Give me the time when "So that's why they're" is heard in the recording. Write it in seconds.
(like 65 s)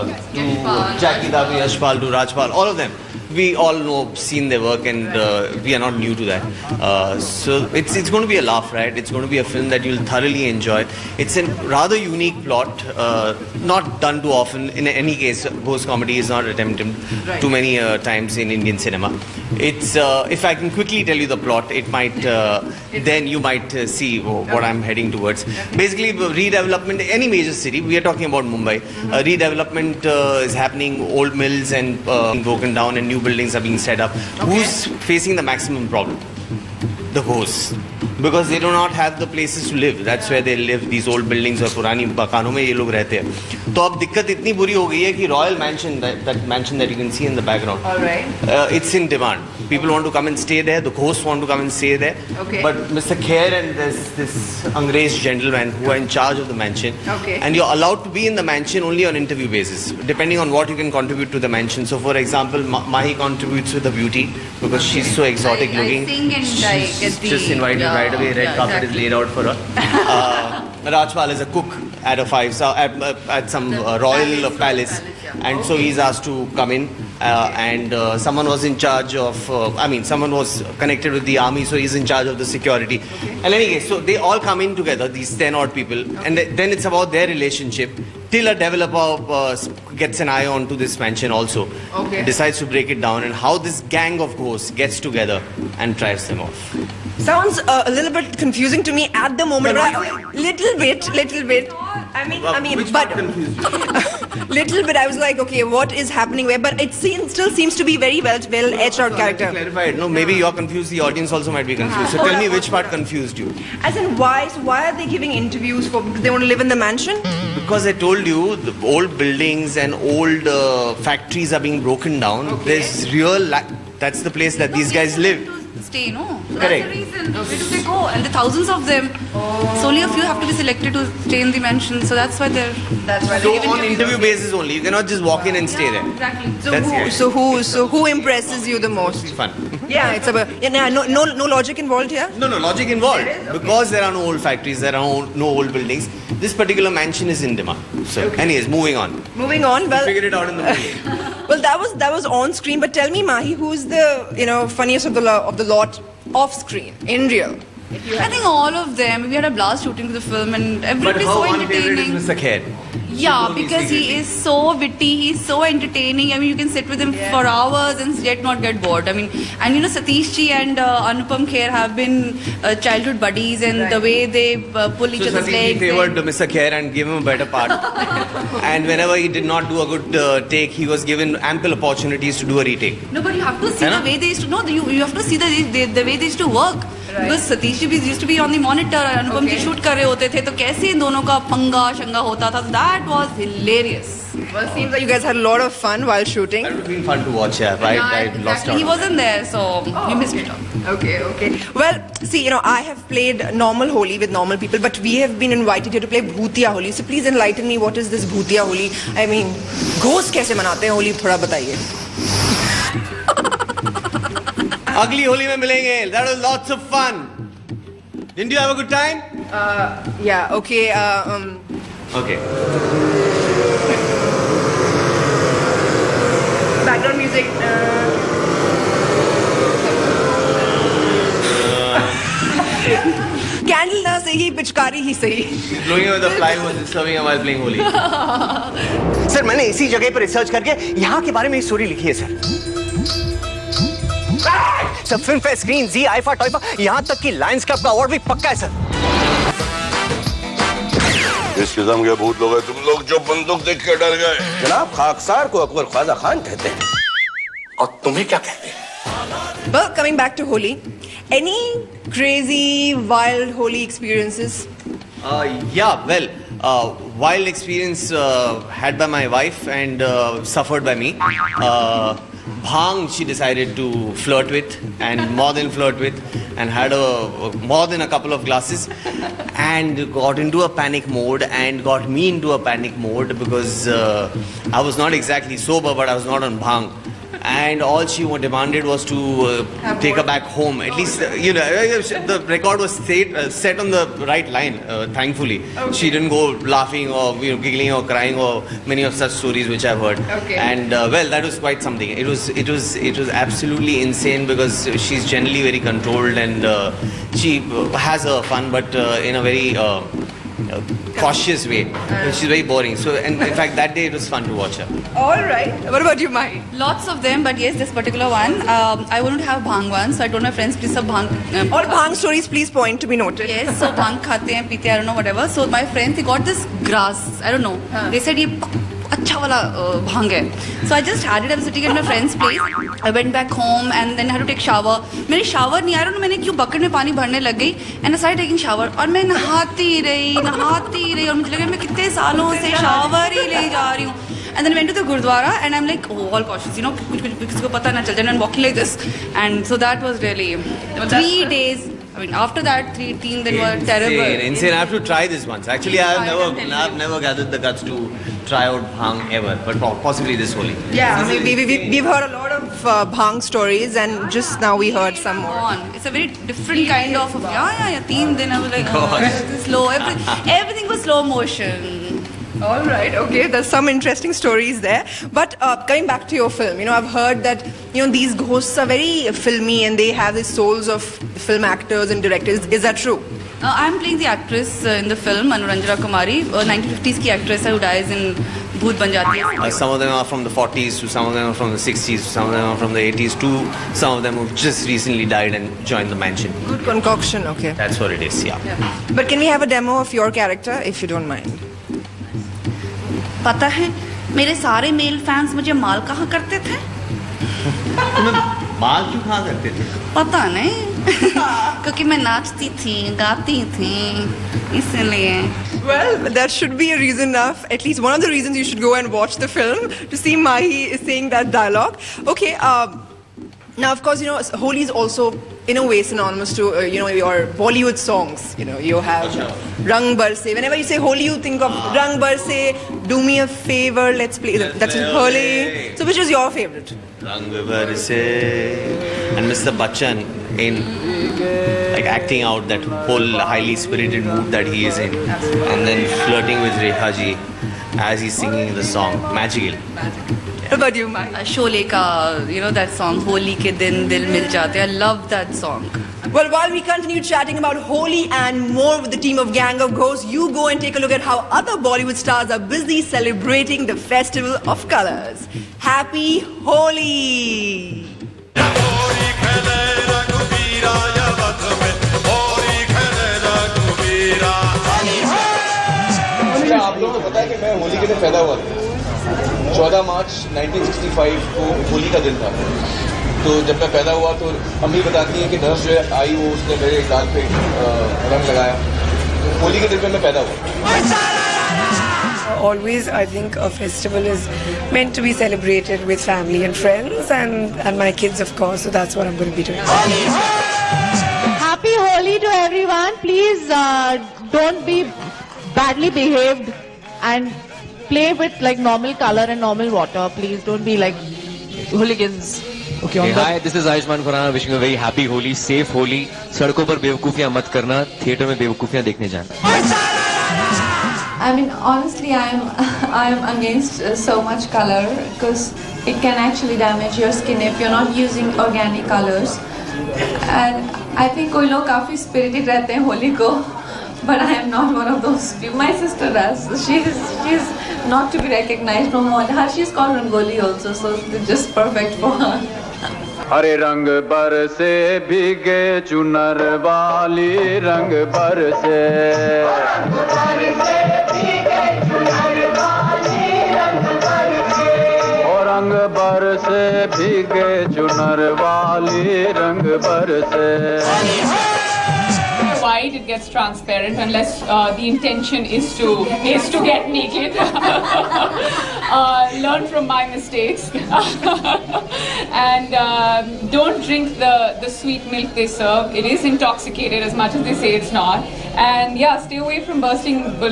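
132 s.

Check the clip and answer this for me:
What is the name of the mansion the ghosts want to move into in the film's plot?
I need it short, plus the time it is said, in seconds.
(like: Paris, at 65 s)
Royal Mansion, at 45 s.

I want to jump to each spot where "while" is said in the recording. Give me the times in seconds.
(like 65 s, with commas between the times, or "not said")
196 s, 456 s.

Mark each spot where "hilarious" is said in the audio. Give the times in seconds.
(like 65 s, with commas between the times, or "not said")
193 s.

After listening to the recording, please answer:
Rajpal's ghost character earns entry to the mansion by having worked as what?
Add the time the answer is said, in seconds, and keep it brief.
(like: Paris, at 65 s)
Cook, at 71 s.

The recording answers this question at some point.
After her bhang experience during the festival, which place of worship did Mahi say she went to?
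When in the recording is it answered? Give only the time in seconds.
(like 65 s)
345 s.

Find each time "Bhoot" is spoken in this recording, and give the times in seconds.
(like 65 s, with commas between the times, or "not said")
388 s.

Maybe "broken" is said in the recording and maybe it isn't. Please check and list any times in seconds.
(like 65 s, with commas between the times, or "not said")
32 s, 121 s.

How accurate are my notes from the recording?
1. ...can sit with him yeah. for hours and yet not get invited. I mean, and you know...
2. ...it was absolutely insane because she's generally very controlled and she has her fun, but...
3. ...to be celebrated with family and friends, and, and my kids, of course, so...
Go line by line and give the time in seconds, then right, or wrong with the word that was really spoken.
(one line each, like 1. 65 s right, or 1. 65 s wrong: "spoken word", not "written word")
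1. 166 s wrong: "bored", not "invited"
2. 302 s right
3. 495 s right.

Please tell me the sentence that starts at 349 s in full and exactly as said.
And so that was really three days I mean, after that, three teen then were terrible.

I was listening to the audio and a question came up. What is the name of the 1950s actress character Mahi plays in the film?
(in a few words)
Anuranjana Kumari.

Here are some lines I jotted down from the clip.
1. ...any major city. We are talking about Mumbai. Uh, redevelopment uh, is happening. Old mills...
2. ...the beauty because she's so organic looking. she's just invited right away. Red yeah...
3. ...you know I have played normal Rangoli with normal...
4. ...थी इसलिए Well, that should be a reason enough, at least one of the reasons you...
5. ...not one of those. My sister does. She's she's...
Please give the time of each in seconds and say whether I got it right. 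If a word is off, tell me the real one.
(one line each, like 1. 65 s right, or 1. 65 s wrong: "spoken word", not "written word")
1. 27 s right
2. 63 s wrong: "exotic", not "organic"
3. 202 s wrong: "Holi", not "Rangoli"
4. 413 s right
5. 534 s right.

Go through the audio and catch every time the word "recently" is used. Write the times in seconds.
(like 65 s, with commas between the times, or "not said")
394 s.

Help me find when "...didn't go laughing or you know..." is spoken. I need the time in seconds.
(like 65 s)
296 s.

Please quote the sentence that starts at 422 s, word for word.
Okay, uh, now of course, you know, Holi is also in a way synonymous to uh, you know your Bollywood songs.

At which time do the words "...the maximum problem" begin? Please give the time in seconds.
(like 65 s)
35 s.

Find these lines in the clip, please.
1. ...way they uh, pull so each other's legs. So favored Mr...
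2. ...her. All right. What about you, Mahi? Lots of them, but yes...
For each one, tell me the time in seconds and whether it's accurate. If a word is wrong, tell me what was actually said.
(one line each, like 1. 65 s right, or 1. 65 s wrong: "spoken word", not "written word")
1. 174 s right
2. 314 s right.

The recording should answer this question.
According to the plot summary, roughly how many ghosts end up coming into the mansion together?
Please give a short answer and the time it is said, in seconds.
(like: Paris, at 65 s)
10, at 85 s.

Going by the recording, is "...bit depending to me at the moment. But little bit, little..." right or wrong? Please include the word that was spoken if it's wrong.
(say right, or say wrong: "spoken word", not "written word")
wrong: "confusing", not "depending".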